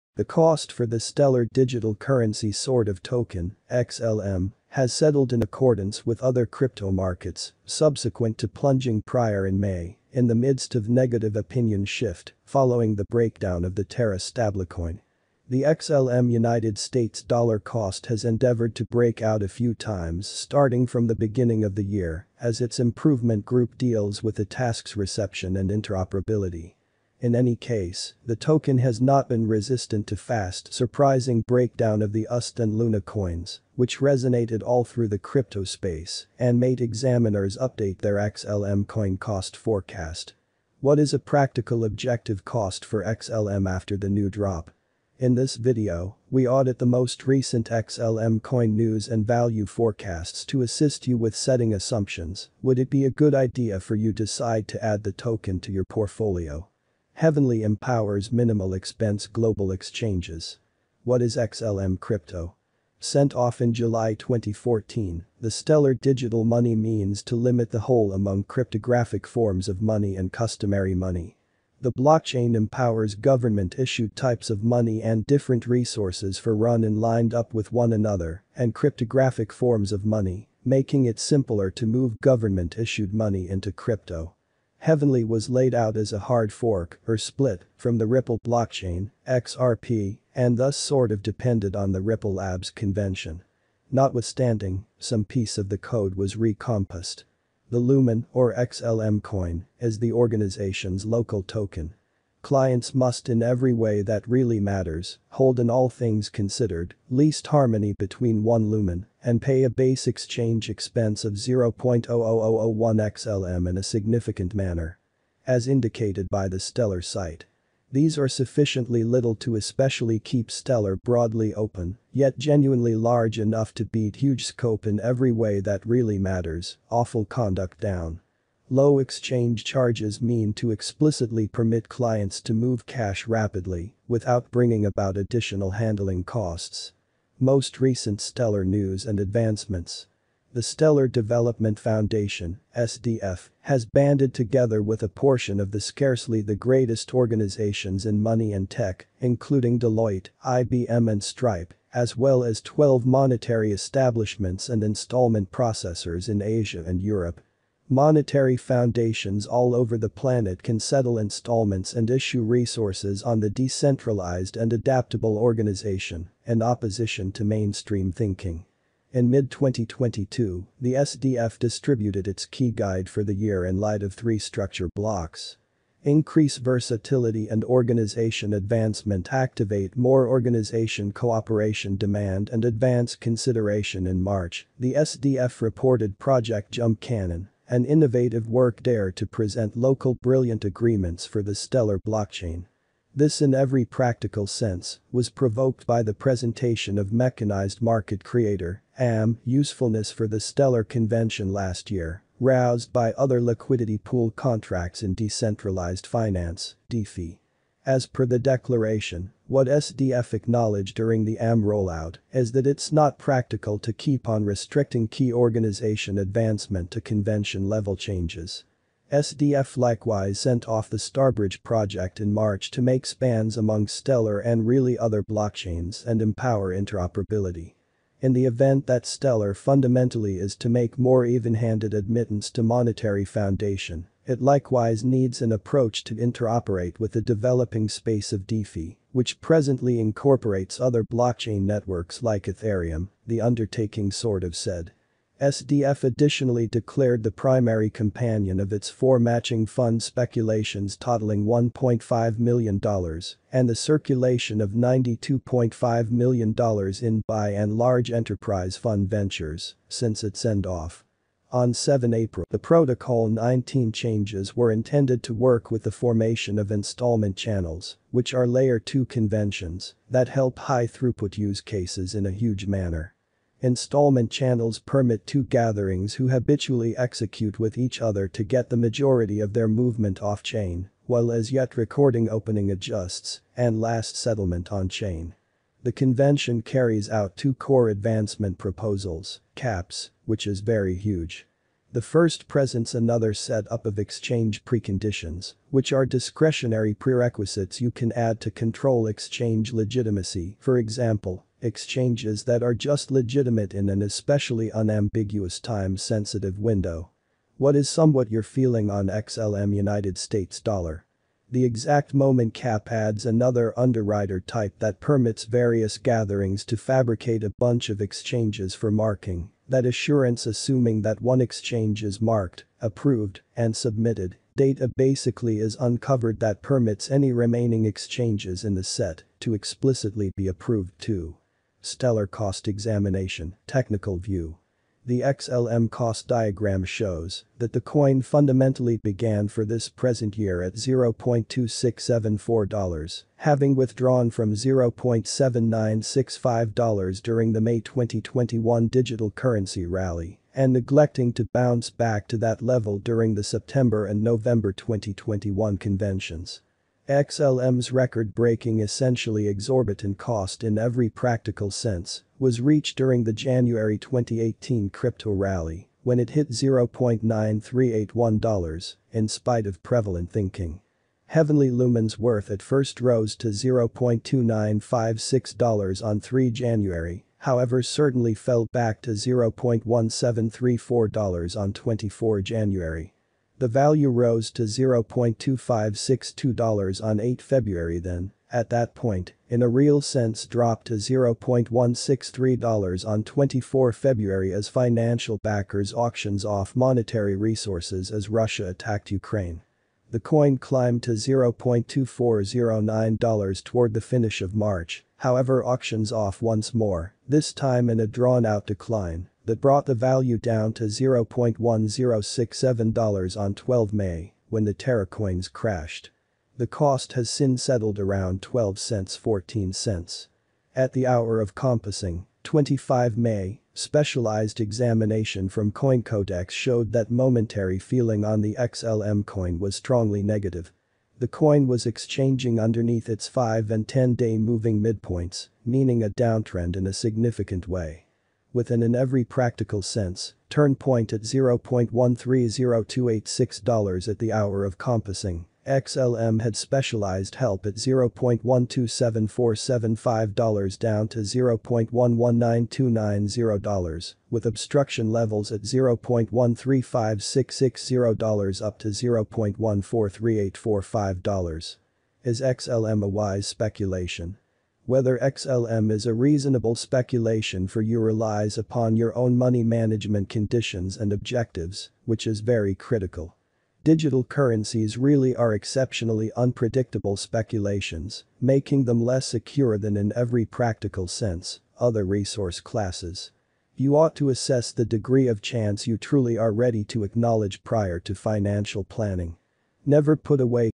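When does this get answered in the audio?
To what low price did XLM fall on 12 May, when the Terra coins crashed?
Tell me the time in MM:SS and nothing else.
06:50.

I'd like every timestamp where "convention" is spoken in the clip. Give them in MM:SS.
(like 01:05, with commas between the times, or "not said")
01:32, 03:20, 03:37, 04:29, 04:45, 05:55.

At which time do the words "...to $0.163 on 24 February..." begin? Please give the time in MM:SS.
06:30.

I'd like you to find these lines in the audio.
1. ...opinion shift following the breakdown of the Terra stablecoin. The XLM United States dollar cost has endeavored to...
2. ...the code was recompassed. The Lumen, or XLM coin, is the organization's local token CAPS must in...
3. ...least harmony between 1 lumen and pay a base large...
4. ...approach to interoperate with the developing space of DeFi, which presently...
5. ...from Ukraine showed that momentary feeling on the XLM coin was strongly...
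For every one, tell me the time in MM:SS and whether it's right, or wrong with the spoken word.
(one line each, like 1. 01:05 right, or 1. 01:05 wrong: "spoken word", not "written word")
1. 00:11 right
2. 01:35 wrong: "Clients", not "CAPS"
3. 01:47 wrong: "exchange", not "large"
4. 03:55 right
5. 07:05 wrong: "CoinCodex", not "Ukraine".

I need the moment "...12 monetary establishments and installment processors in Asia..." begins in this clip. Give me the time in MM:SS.
02:32.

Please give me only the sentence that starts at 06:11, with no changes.
Heavenly Lumen's worth at first rose to $0.2956 on 3 January, however certainly fell back to $0.1734 on 24 January.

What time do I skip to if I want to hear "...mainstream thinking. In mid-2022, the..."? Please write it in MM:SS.
02:47.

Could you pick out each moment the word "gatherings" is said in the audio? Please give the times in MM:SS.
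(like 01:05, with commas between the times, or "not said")
04:35, 05:15.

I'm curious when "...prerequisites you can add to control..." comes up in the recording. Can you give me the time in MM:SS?
04:56.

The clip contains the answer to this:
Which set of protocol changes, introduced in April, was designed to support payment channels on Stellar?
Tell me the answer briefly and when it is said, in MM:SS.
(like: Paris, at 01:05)
Protocol 19, at 04:22.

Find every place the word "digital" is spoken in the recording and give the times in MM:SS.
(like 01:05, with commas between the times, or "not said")
00:01, 01:05, 05:48, 07:53.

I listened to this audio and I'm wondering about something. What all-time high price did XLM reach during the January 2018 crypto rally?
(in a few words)
$0.9381.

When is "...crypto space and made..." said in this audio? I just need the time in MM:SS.
00:35.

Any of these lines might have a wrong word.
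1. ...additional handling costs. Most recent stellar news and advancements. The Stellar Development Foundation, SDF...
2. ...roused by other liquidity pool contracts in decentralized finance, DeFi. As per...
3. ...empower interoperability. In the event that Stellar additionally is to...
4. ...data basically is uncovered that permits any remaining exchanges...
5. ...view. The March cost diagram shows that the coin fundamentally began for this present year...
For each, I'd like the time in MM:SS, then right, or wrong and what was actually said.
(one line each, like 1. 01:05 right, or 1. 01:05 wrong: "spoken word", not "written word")
1. 02:15 right
2. 03:22 right
3. 03:46 wrong: "fundamentally", not "additionally"
4. 05:24 right
5. 05:34 wrong: "XLM", not "March".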